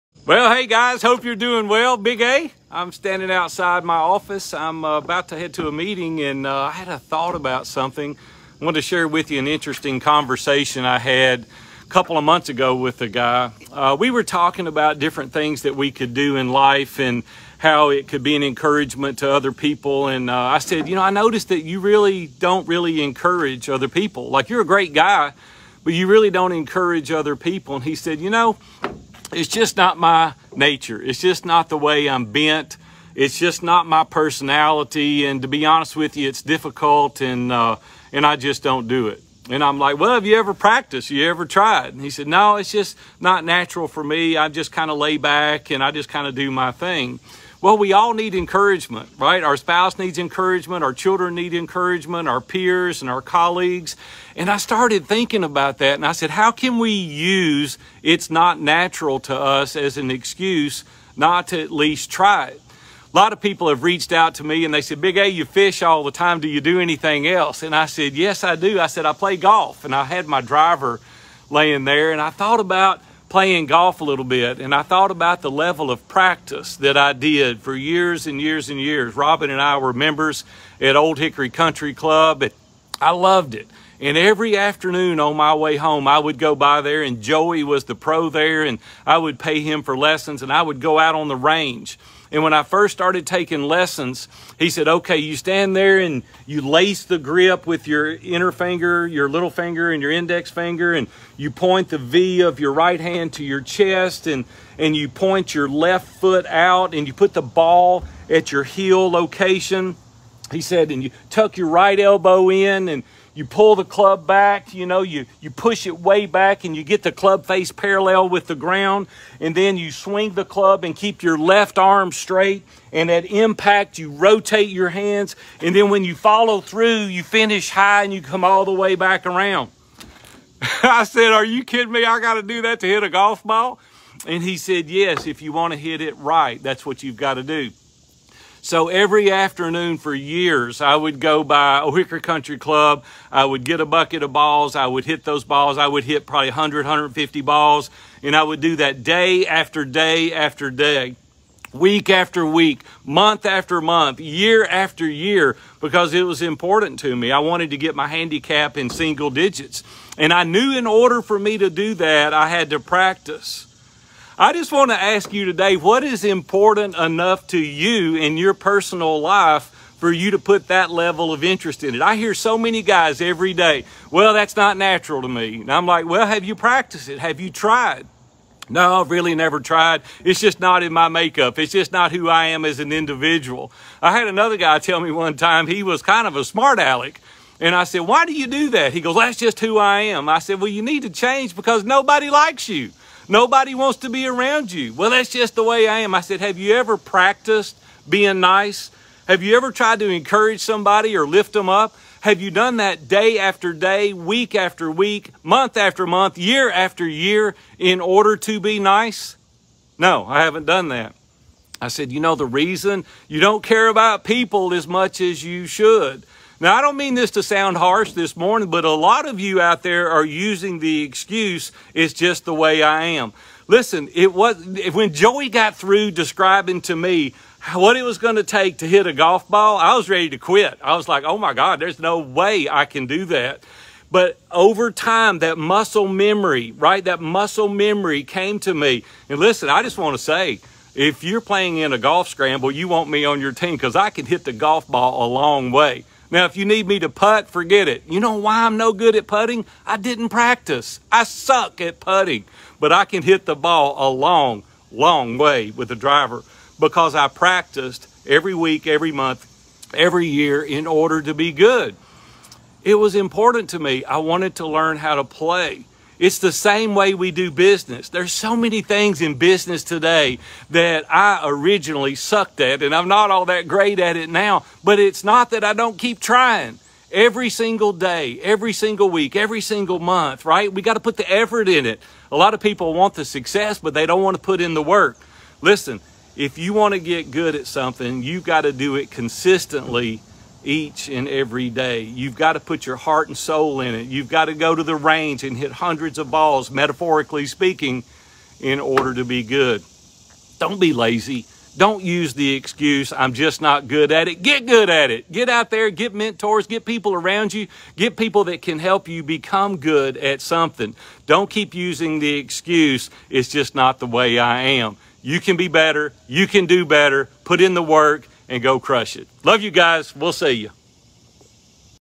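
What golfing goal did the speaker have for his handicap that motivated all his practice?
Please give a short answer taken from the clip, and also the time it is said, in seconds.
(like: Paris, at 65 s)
single digits, at 158 s.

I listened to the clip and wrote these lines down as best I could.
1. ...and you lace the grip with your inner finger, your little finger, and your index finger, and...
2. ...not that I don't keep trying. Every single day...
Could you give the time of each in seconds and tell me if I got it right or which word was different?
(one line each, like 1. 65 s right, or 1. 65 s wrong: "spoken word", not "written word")
1. 95 s right
2. 275 s right.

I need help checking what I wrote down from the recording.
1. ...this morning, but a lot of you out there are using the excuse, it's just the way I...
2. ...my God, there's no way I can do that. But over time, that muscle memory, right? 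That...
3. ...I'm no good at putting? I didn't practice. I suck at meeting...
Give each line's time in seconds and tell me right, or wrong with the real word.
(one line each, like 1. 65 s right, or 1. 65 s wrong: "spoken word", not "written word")
1. 218 s right
2. 231 s right
3. 248 s wrong: "putting", not "meeting".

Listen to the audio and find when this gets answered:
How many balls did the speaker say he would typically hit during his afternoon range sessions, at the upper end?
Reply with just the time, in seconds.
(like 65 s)
146 s.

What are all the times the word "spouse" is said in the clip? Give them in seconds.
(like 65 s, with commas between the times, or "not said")
49 s.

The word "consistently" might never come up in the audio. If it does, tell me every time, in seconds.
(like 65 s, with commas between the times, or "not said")
289 s.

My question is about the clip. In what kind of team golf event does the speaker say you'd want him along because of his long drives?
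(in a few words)
a golf scramble.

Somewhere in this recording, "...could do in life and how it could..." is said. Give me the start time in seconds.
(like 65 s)
15 s.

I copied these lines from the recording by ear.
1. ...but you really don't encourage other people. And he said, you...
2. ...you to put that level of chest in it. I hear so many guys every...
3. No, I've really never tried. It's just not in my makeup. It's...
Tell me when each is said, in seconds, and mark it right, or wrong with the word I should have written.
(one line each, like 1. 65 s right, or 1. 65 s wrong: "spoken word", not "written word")
1. 25 s right
2. 170 s wrong: "interest", not "chest"
3. 178 s right.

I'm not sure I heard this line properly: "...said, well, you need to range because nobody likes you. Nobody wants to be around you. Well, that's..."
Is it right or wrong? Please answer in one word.
wrong.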